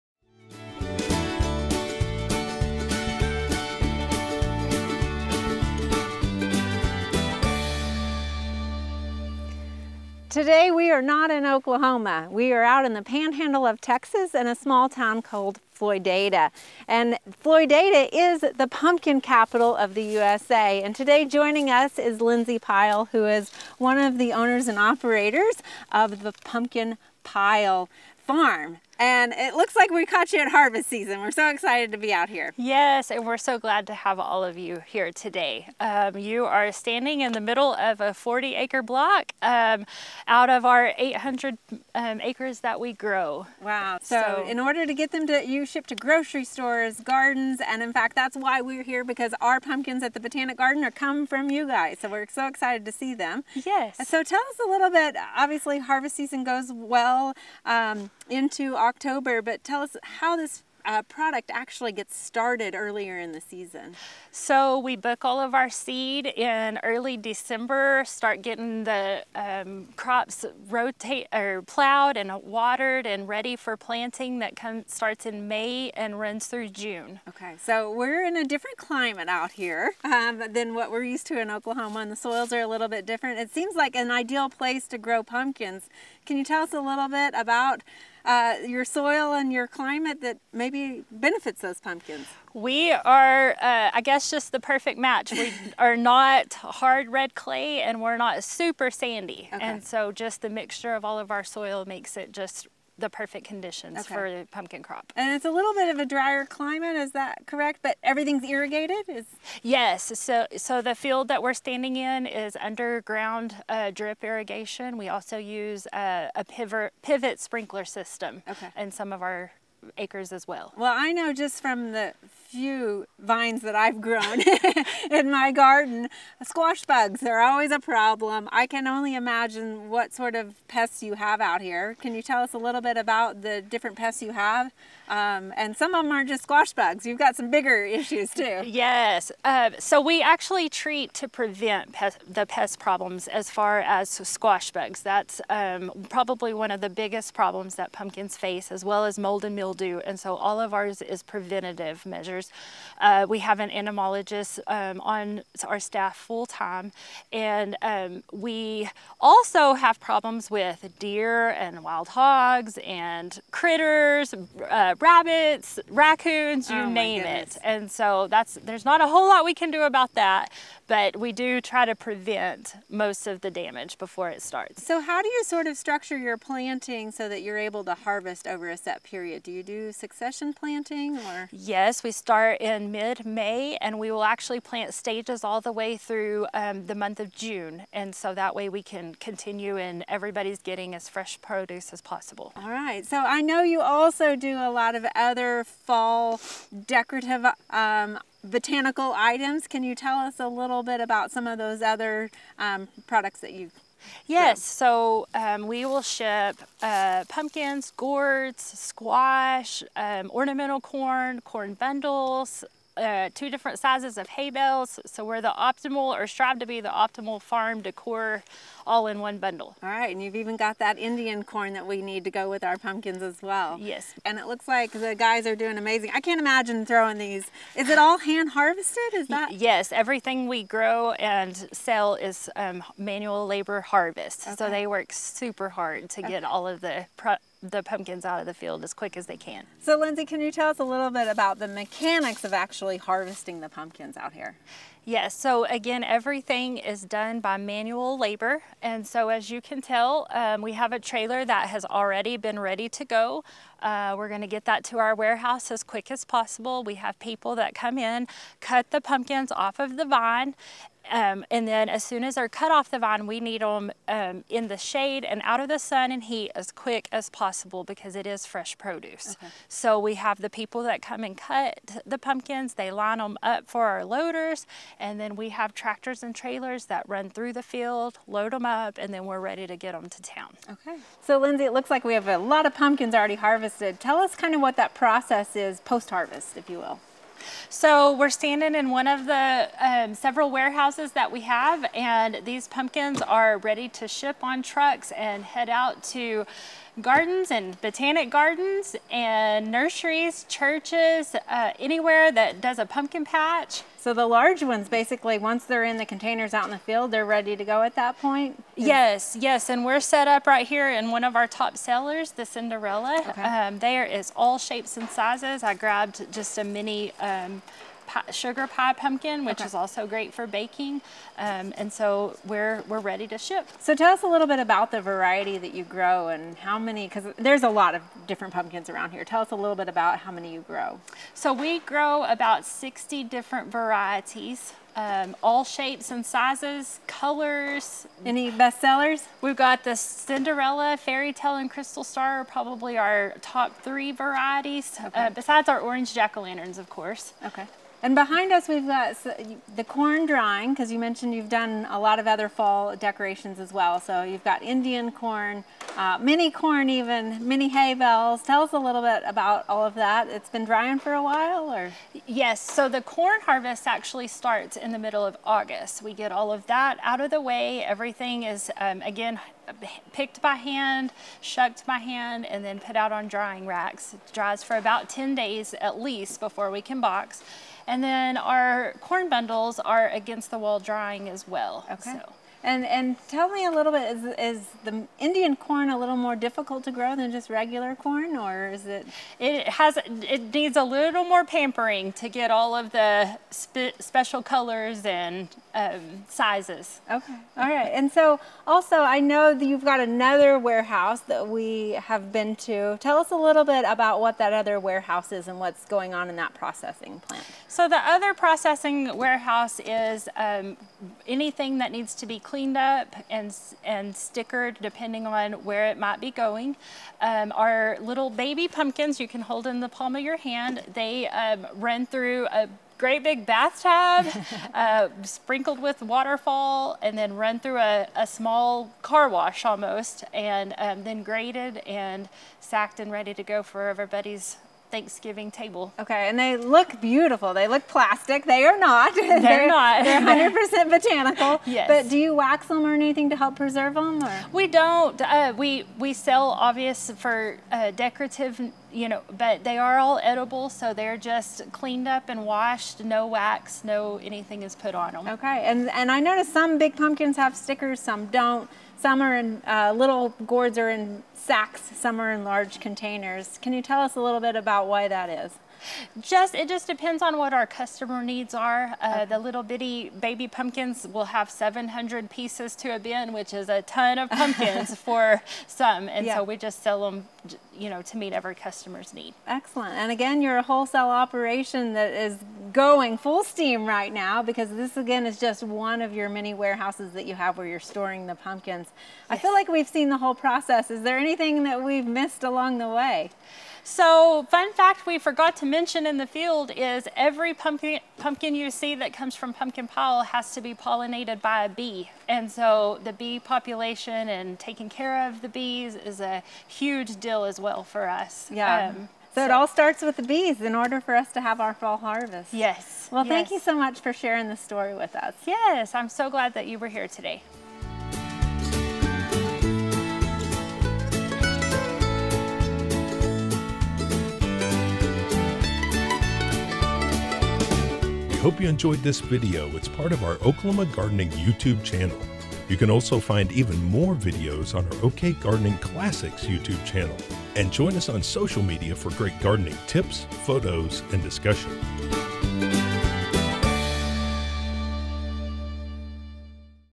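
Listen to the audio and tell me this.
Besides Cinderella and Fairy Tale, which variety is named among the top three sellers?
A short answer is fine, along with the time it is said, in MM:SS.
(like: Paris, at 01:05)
Crystal Star, at 05:41.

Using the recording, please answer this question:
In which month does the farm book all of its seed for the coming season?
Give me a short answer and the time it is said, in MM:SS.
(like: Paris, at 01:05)
December, at 01:06.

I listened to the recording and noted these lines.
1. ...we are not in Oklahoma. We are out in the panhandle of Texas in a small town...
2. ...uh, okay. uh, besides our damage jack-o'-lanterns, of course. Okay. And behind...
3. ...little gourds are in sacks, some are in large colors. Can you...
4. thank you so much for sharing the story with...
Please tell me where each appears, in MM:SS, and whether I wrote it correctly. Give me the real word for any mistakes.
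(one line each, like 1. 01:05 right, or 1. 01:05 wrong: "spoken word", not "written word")
1. 00:10 right
2. 05:45 wrong: "orange", not "damage"
3. 07:39 wrong: "containers", not "colors"
4. 08:33 right.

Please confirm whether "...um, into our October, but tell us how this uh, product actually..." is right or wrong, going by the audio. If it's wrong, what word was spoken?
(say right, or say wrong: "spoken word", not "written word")
right.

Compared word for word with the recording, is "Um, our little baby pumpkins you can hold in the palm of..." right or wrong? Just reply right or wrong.
right.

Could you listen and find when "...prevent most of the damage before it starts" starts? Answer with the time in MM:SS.
02:51.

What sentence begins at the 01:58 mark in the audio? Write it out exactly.
in some of our acres as well.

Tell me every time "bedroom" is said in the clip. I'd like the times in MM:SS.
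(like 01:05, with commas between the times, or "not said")
not said.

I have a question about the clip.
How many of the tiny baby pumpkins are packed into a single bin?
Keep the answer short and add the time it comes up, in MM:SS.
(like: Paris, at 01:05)
700, at 07:51.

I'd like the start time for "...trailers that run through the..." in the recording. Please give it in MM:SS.
04:36.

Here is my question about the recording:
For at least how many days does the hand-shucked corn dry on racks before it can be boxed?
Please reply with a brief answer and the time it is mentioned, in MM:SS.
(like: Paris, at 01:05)
10 days, at 06:15.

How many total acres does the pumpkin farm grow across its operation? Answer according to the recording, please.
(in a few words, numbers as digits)
800.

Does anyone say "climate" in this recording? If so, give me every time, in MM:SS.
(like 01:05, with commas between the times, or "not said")
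01:18, 01:29, 01:46.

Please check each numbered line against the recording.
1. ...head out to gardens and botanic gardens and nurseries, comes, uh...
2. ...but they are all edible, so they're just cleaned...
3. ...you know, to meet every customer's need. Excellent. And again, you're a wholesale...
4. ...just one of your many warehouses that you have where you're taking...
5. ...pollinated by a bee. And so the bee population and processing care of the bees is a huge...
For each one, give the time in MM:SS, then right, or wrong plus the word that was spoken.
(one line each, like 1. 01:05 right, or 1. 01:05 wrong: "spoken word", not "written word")
1. 04:55 wrong: "churches", not "comes"
2. 07:29 right
3. 07:57 right
4. 08:05 wrong: "storing", not "taking"
5. 08:20 wrong: "taking", not "processing".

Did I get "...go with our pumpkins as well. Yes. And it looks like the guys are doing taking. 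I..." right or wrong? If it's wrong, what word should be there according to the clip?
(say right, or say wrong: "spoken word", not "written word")
wrong: "amazing", not "taking".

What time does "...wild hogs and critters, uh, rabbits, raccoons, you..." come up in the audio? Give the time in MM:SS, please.
02:41.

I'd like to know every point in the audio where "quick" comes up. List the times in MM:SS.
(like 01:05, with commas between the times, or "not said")
03:58, 04:15, 04:26.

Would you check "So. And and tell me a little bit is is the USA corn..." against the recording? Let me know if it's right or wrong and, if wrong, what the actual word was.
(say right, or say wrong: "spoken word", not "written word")
wrong: "Indian", not "USA".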